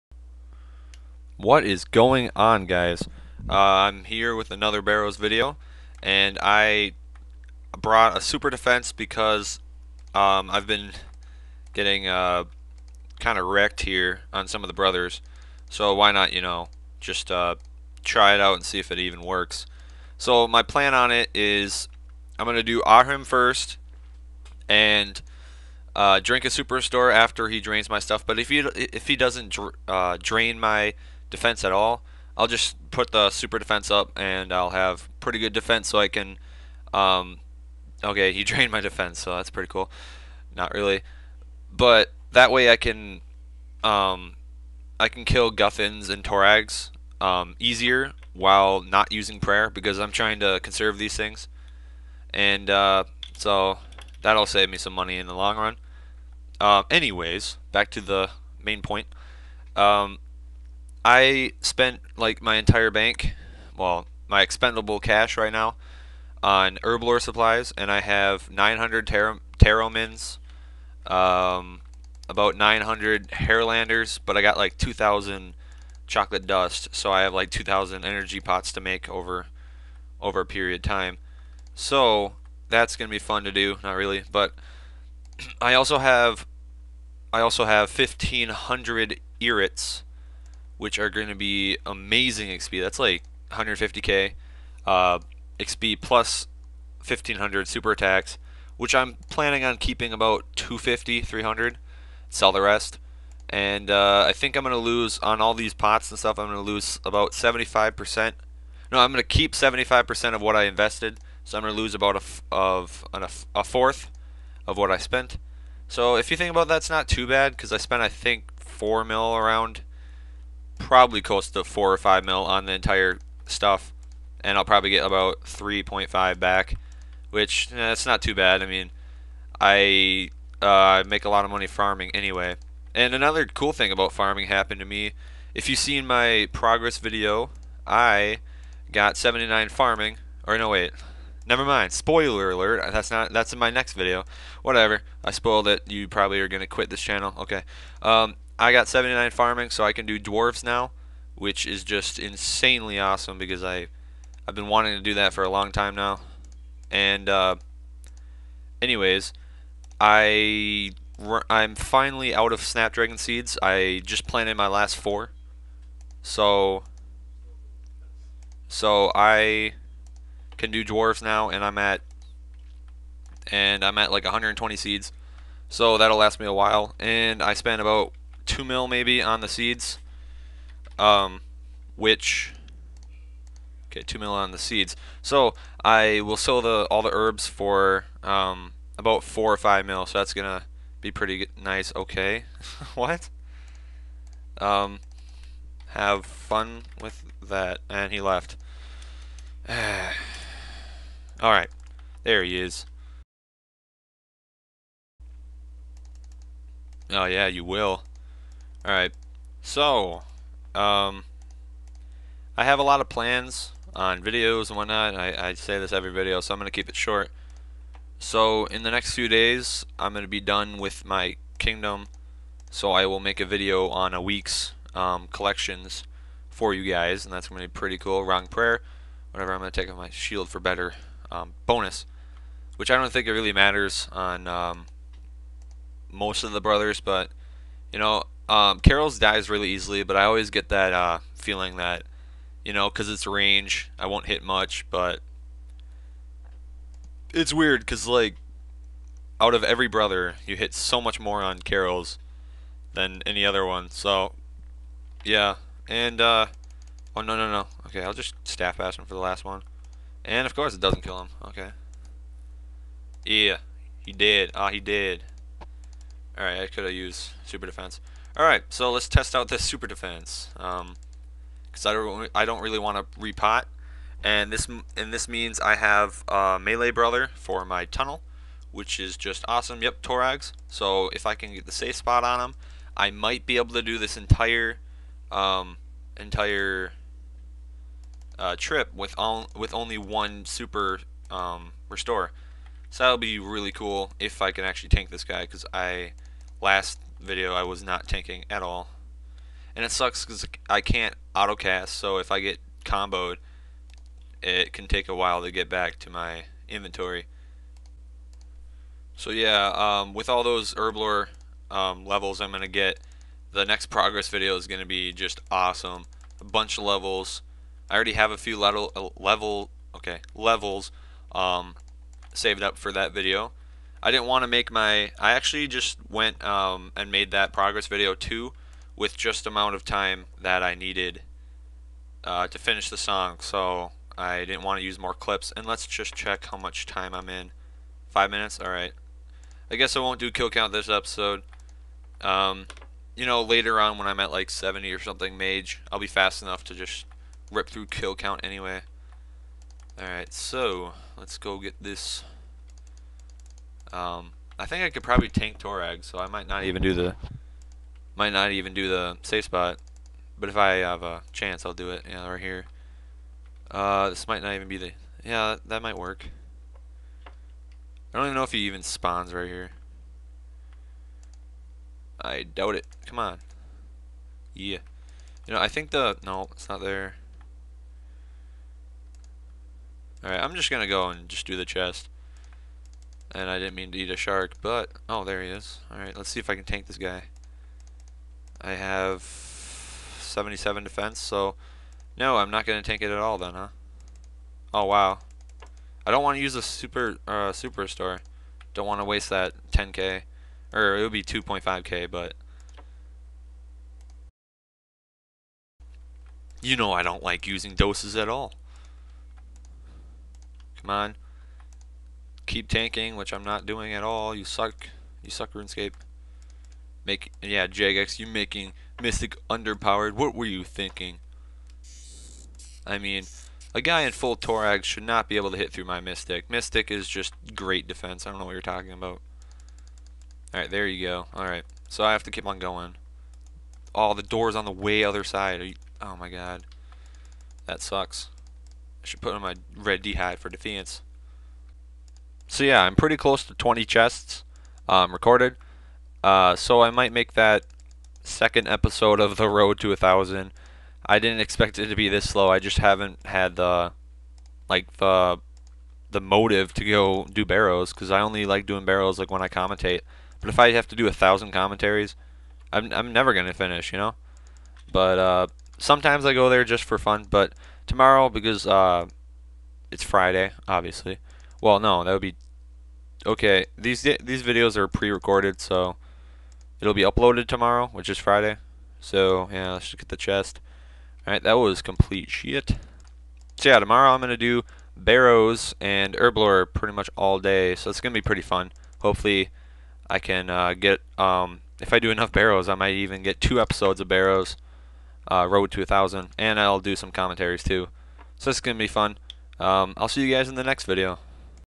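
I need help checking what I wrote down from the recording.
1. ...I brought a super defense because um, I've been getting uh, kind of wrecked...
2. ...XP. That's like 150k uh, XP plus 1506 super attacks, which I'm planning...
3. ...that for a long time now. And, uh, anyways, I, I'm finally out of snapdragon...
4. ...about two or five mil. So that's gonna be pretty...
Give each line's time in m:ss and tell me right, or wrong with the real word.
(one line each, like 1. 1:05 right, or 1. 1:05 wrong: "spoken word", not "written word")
1. 0:06 right
2. 1:32 wrong: "1500", not "1506"
3. 2:35 right
4. 3:08 wrong: "four", not "two".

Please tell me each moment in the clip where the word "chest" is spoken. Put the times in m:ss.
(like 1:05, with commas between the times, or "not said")
6:21, 7:23, 8:00.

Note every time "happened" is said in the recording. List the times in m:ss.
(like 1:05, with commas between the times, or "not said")
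2:14.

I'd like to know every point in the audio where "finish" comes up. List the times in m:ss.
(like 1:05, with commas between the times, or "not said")
5:32, 7:43.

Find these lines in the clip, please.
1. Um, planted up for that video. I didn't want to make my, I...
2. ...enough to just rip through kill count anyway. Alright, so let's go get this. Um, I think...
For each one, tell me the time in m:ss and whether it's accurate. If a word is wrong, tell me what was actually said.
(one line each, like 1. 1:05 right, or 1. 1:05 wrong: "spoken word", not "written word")
1. 5:21 wrong: "saved", not "planted"
2. 5:46 right.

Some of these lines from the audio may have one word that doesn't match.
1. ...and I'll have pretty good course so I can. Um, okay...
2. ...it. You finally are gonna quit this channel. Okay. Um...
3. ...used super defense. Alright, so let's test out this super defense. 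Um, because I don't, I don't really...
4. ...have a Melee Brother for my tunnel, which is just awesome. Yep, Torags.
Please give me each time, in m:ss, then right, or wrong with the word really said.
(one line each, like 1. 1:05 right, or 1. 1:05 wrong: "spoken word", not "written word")
1. 0:34 wrong: "defense", not "course"
2. 2:25 wrong: "probably", not "finally"
3. 4:26 right
4. 4:35 right.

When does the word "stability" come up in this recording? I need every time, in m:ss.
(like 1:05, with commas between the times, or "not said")
not said.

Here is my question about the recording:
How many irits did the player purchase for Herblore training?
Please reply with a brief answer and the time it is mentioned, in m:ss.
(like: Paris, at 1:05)
1,500, at 1:27.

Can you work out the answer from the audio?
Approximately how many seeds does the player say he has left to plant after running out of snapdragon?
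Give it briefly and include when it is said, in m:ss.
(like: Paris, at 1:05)
120, at 2:54.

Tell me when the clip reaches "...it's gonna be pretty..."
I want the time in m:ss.
8:07.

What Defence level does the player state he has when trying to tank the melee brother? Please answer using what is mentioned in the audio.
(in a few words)
77.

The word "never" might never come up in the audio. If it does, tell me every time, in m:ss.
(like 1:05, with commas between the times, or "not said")
2:21, 7:43.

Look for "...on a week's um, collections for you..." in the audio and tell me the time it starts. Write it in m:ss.
3:43.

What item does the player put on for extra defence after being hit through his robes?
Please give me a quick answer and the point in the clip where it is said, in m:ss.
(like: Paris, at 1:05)
red D hat, at 7:19.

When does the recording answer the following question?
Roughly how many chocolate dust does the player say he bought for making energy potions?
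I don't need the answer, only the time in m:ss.
1:14.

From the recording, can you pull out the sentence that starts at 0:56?
Uh, anyways, back to the main point.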